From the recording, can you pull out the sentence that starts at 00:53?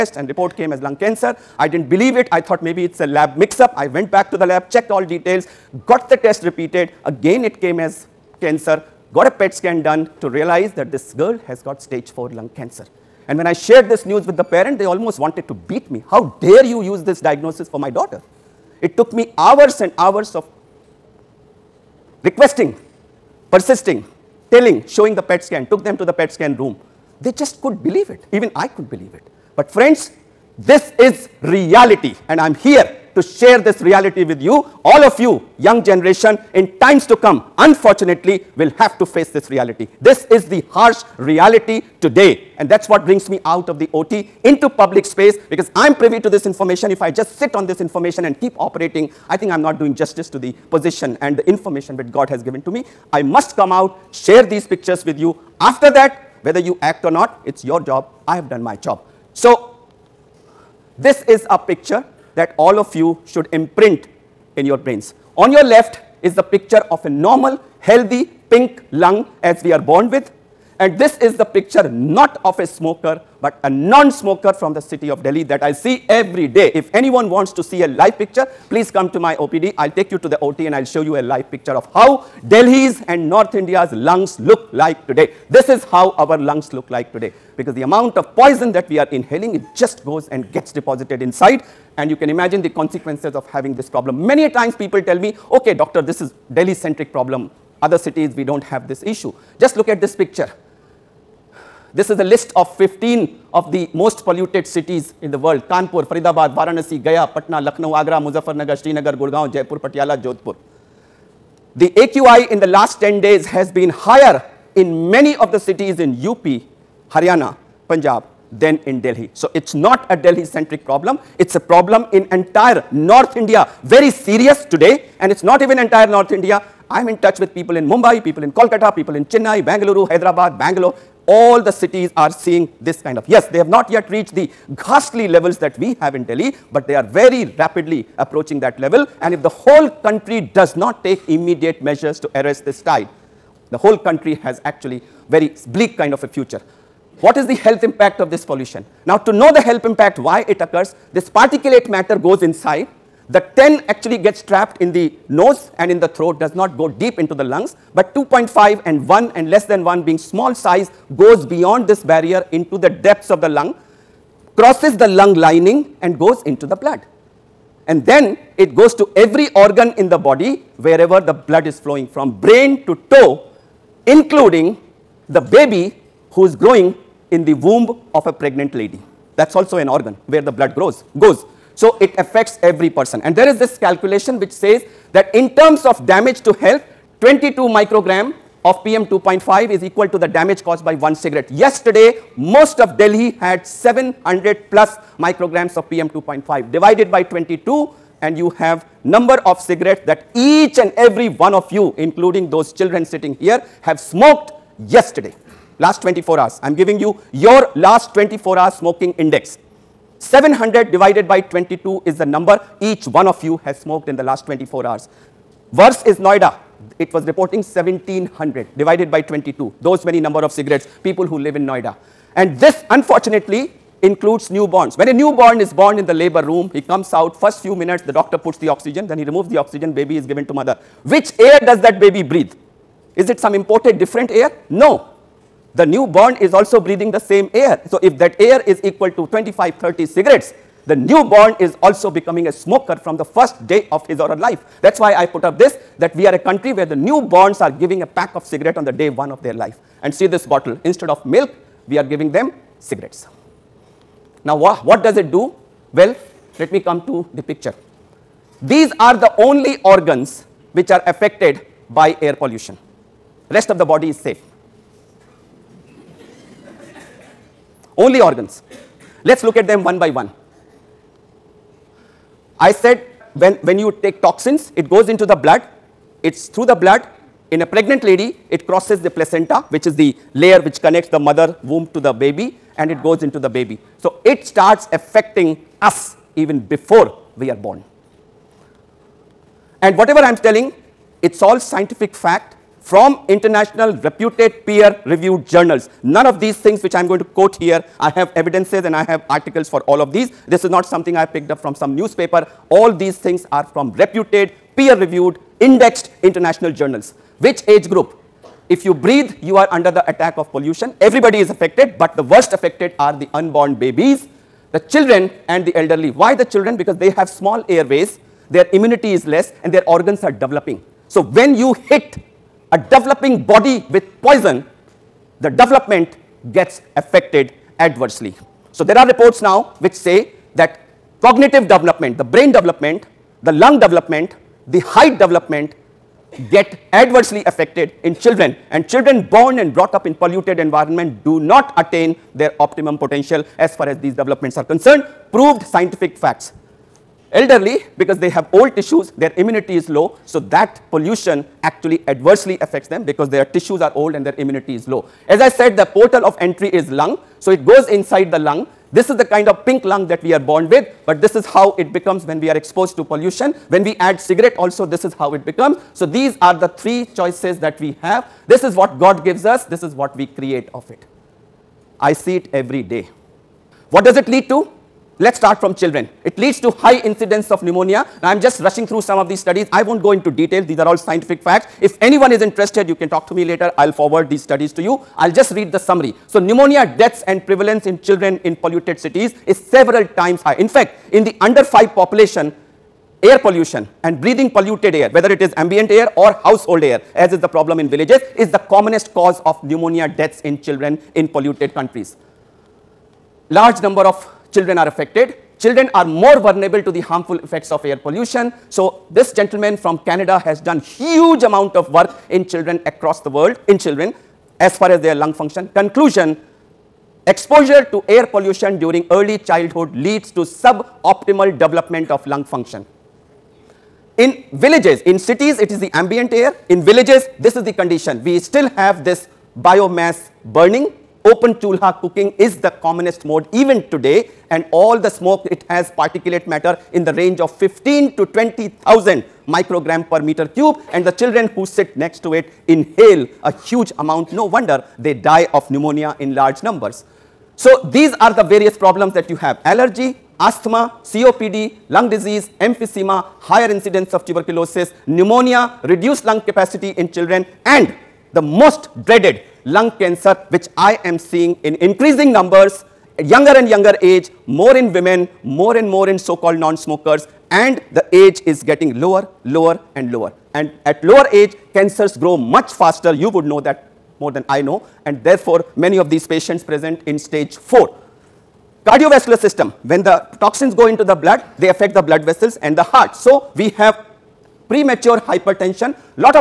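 I must come out, share these pictures with you.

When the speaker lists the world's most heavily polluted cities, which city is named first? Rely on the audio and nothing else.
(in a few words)
Kanpur.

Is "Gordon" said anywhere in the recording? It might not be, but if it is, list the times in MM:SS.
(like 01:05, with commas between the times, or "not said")
not said.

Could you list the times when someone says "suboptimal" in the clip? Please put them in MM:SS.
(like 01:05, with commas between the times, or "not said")
07:00.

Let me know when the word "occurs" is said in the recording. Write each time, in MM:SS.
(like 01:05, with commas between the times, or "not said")
02:30.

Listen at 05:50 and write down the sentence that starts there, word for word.
So, that pollution actually adversely affects them because their tissues are old and their immunity is low.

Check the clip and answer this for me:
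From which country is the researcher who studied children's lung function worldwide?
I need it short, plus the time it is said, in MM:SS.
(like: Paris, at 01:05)
Canada, at 06:50.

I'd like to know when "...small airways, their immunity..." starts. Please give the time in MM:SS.
05:17.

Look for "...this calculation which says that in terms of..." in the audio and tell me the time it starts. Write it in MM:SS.
03:03.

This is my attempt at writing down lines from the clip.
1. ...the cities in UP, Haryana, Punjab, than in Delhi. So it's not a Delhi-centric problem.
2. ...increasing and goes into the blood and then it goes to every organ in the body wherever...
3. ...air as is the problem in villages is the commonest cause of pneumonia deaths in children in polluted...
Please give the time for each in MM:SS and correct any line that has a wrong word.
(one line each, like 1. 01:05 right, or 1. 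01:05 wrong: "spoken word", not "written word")
1. 01:55 right
2. 02:45 wrong: "lining", not "increasing"
3. 06:36 right.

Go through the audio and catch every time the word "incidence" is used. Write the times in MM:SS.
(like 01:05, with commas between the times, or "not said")
06:17, 07:33.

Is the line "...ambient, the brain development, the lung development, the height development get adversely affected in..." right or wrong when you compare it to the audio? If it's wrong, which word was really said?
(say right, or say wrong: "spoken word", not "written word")
wrong: "development", not "ambient".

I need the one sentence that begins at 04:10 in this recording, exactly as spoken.
And see this bottle, instead of milk, we are giving them cigarettes.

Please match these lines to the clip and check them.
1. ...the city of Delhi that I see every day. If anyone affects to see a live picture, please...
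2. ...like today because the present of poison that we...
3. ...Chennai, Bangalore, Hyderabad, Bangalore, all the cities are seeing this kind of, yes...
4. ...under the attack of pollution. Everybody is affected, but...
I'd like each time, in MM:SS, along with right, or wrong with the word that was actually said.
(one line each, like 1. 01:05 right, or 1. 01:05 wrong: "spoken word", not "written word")
1. 01:14 wrong: "wants", not "affects"
2. 01:26 wrong: "amount", not "present"
3. 02:09 right
4. 05:09 right.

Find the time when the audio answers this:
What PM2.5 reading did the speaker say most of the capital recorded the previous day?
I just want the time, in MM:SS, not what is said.
03:13.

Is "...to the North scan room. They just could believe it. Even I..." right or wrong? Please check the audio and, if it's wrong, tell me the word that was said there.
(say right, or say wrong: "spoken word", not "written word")
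wrong: "PET", not "North".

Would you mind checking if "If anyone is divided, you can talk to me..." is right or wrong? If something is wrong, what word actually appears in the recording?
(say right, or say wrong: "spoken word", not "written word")
wrong: "interested", not "divided".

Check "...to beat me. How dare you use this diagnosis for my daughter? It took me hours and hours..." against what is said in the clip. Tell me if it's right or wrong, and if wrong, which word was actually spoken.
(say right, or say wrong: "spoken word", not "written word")
right.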